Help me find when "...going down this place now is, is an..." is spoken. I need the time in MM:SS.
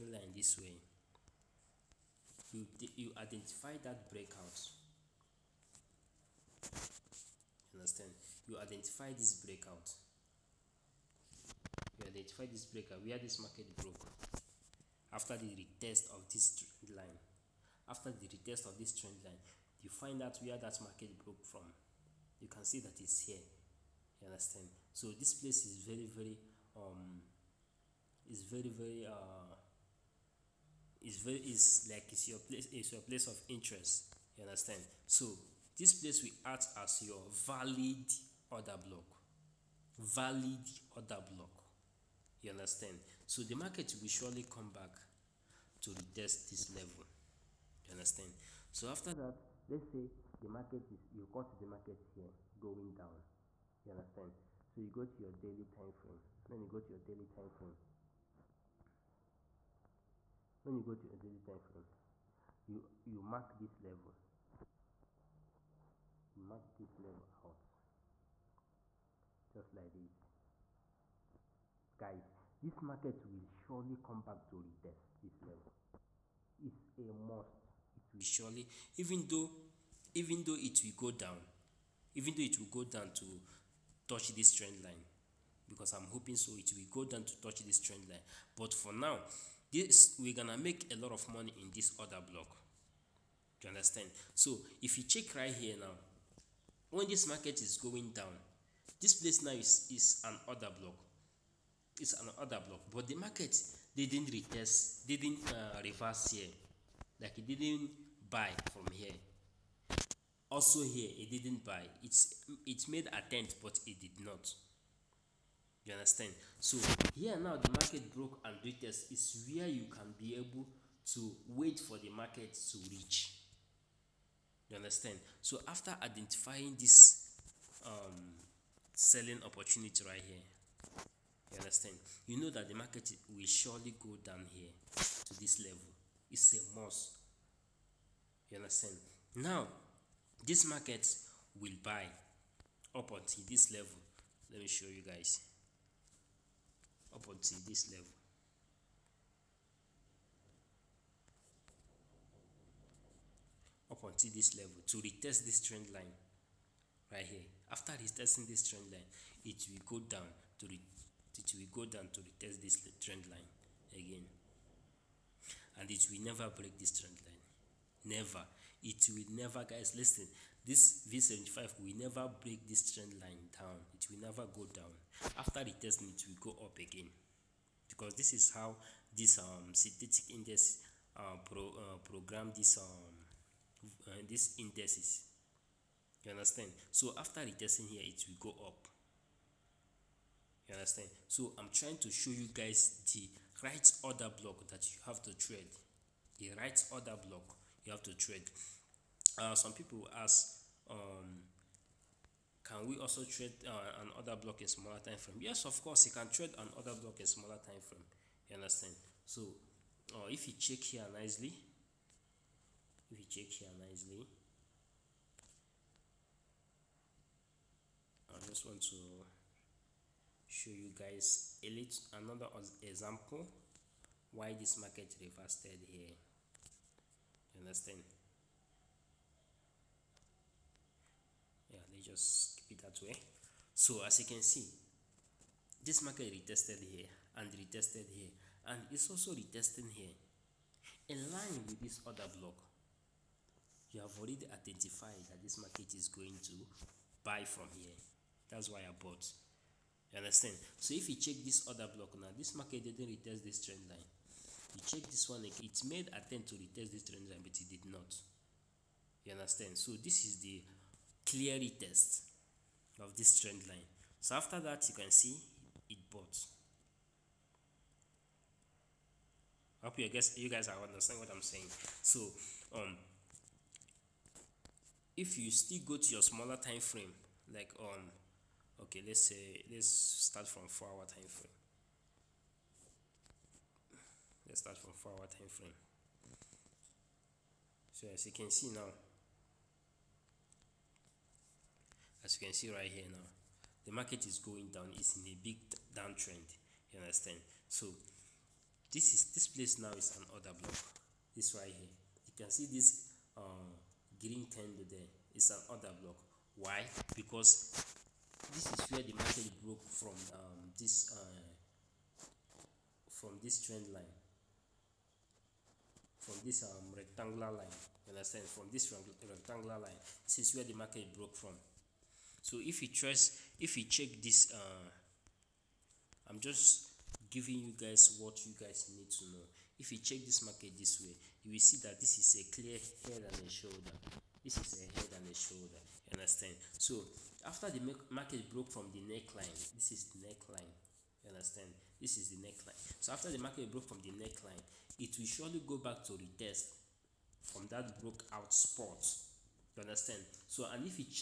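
01:37.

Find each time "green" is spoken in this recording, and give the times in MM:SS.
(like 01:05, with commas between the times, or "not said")
05:04.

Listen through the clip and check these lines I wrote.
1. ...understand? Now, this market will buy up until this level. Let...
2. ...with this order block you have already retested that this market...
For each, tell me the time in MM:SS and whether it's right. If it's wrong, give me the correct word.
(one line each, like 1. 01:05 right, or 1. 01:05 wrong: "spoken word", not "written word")
1. 02:18 right
2. 04:01 wrong: "identified", not "retested".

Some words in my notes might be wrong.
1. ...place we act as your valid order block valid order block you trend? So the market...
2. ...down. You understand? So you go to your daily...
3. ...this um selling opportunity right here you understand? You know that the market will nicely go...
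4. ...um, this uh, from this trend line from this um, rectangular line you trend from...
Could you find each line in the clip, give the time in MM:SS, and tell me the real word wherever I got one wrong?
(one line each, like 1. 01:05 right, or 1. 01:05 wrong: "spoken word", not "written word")
1. 00:35 wrong: "understand", not "trend"
2. 00:52 right
3. 02:06 wrong: "surely", not "nicely"
4. 05:10 wrong: "understand", not "trend".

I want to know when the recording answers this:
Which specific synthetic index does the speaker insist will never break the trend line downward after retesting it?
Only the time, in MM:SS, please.
02:51.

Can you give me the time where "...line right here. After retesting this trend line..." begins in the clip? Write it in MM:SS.
02:35.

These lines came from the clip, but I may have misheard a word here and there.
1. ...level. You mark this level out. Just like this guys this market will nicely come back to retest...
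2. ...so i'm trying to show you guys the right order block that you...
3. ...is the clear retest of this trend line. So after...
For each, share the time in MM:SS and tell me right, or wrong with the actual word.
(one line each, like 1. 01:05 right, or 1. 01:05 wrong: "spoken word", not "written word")
1. 01:03 wrong: "surely", not "nicely"
2. 03:11 right
3. 04:20 right.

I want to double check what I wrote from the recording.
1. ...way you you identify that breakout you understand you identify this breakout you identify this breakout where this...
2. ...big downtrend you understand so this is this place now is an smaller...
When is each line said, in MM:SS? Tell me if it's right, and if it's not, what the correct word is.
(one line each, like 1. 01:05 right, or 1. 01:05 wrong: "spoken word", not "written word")
1. 00:00 right
2. 04:55 wrong: "order", not "smaller".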